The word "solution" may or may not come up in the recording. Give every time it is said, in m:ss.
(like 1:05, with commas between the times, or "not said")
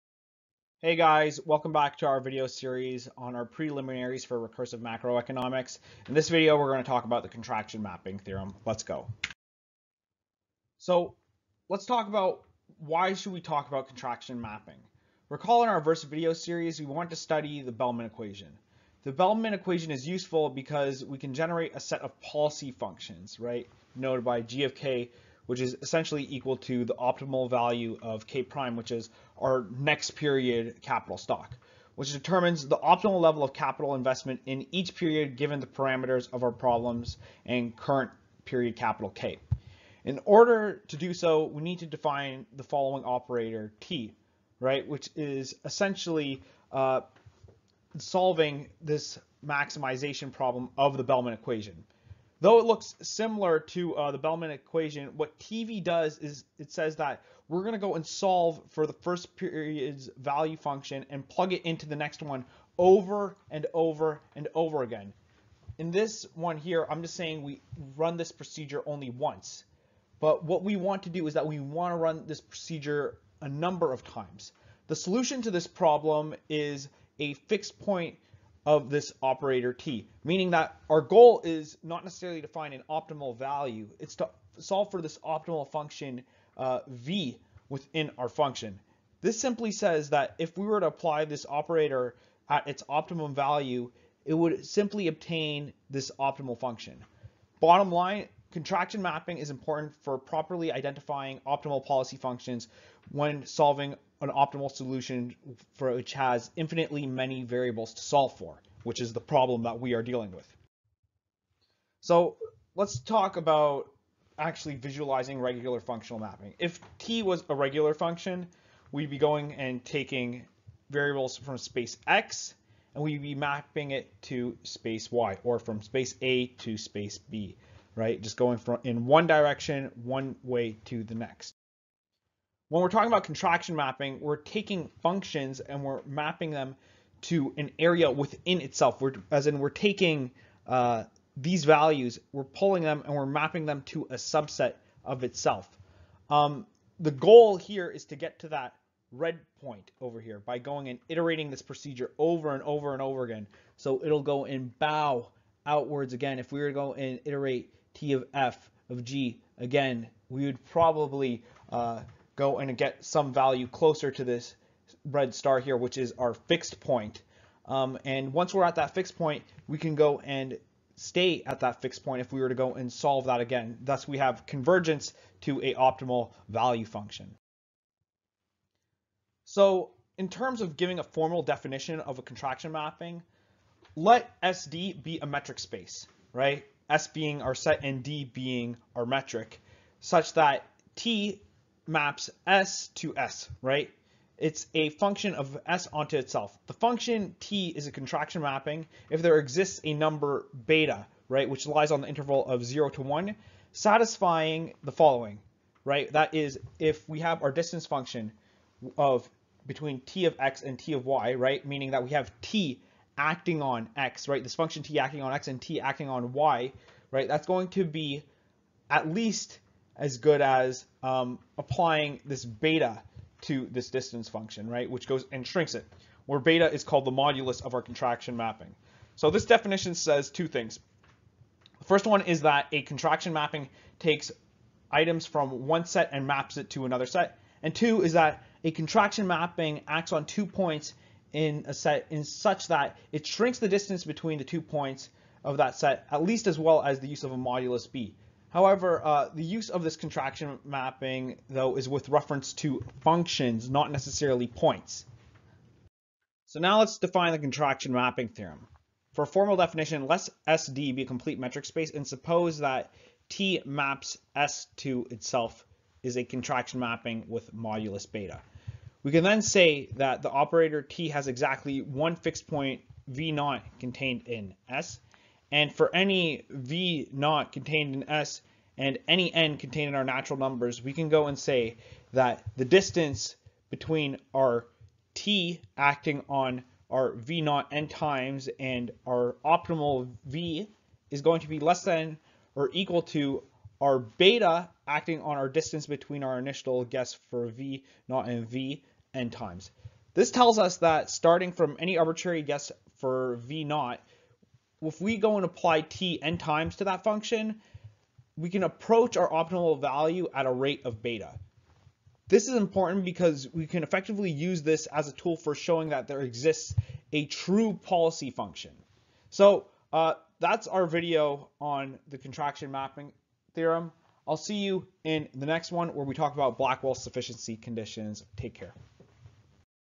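1:14, 1:44.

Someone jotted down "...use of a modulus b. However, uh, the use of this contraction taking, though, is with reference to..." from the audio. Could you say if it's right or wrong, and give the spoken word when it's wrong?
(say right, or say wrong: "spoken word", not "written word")
wrong: "mapping", not "taking".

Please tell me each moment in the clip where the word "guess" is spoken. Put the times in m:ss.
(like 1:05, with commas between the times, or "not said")
4:56, 5:02.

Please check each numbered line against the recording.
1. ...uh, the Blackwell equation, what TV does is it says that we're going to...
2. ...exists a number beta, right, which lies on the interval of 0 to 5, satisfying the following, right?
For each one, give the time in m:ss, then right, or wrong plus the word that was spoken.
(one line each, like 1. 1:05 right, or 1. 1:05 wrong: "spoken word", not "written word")
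1. 0:53 wrong: "Bellman", not "Blackwell"
2. 3:19 wrong: "1", not "5".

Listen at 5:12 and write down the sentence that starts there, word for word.
This is important because we can effectively use this as a tool for showing that there exists a true policy function.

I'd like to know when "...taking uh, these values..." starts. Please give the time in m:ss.
2:19.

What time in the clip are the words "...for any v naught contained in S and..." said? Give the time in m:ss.
4:35.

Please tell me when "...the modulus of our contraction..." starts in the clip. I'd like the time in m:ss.
3:47.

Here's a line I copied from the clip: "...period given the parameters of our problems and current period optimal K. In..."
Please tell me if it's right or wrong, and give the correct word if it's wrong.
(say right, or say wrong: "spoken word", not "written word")
wrong: "capital", not "optimal".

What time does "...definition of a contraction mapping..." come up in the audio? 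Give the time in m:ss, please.
3:01.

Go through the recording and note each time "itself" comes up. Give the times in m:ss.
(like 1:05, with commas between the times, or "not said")
2:18, 2:25, 3:16, 4:25.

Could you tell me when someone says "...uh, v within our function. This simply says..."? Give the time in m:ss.
1:26.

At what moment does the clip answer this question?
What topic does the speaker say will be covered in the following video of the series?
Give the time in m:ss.
5:26.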